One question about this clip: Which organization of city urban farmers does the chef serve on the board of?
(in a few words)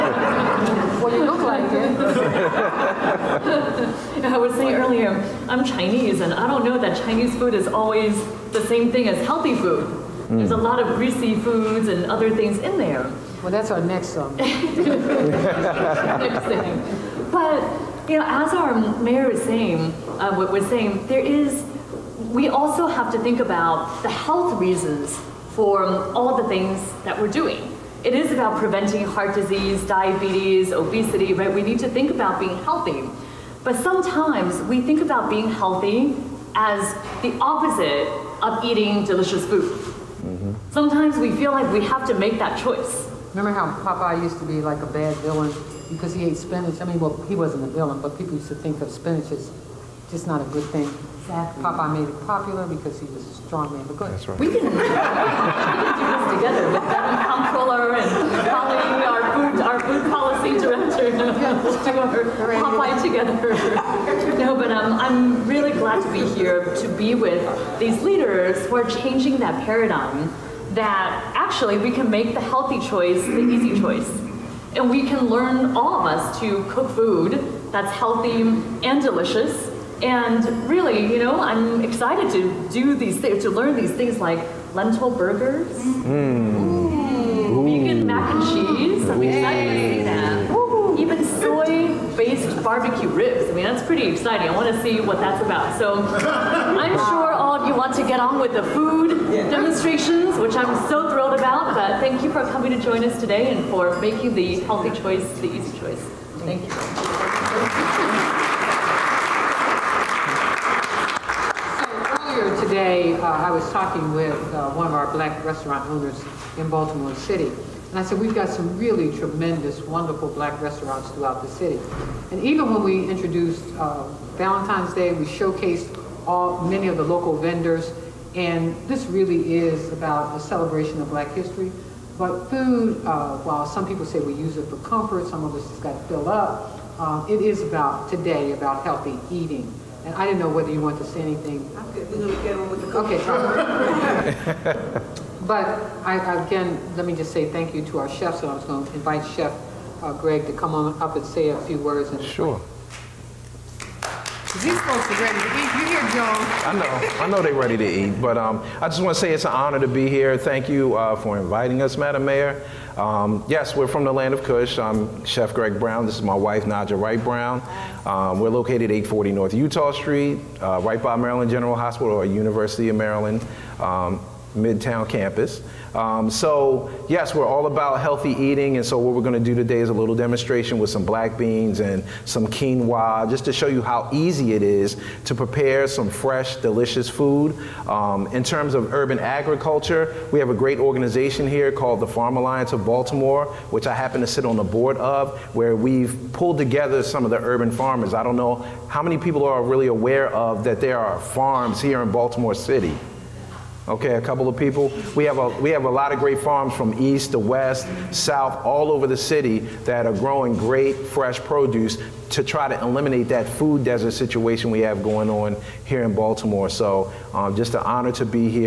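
Farm Alliance of Baltimore.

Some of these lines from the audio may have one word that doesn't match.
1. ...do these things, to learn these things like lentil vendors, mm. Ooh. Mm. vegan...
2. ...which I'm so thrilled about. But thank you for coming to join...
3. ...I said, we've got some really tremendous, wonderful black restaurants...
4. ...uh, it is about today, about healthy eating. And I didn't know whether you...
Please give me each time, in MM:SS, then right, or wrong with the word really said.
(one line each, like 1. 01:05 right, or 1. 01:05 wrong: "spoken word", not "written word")
1. 01:22 wrong: "burgers", not "vendors"
2. 01:40 right
3. 01:57 right
4. 02:16 right.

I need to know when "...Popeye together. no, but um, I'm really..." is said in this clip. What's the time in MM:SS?
01:02.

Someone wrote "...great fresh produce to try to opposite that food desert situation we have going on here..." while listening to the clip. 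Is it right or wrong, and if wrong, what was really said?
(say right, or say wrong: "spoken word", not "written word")
wrong: "eliminate", not "opposite".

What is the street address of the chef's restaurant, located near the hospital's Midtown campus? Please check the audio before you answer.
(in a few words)
840 North Utah Street.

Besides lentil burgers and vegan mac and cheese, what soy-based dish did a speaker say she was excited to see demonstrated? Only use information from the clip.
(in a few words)
barbecue ribs.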